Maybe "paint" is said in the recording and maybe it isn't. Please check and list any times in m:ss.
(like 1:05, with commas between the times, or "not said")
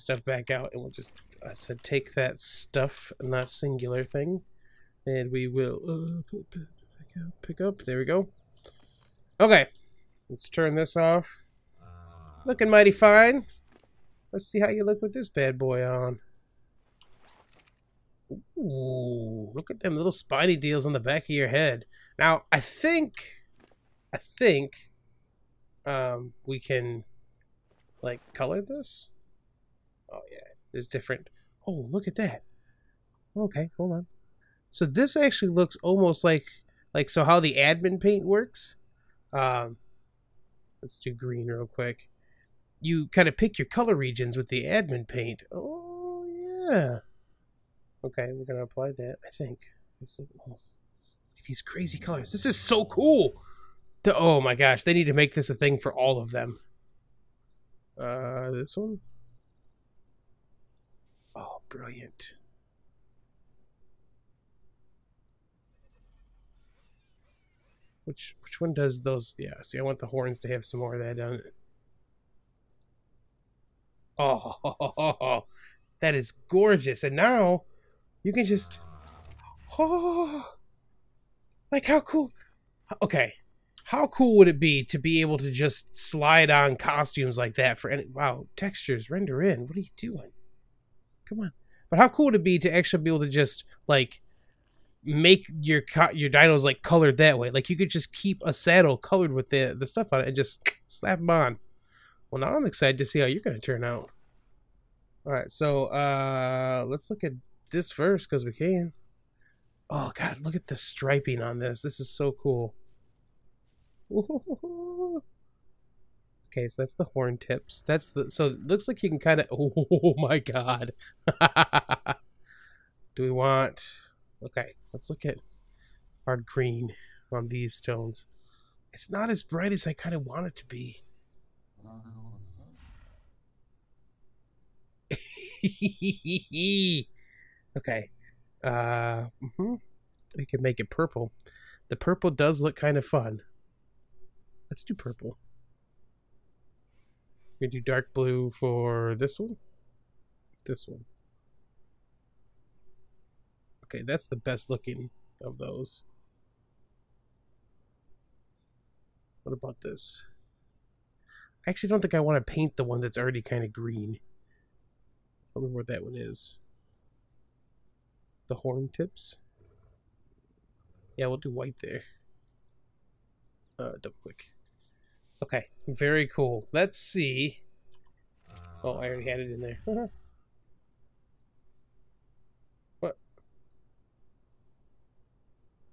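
0:38, 0:45, 2:42.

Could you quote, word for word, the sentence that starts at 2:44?
I wonder where that one is.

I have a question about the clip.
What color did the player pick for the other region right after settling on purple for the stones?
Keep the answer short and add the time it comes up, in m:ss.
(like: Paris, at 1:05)
Dark blue, at 2:27.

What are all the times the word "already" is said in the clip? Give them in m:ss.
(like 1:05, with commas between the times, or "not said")
2:43, 2:59.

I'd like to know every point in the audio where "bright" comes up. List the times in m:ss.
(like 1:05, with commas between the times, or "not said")
2:09.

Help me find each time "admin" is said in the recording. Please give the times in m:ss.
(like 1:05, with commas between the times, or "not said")
0:37, 0:44.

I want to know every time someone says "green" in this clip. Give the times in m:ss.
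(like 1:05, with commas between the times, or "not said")
0:41, 2:06, 2:43.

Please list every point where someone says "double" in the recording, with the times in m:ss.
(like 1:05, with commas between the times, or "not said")
2:54.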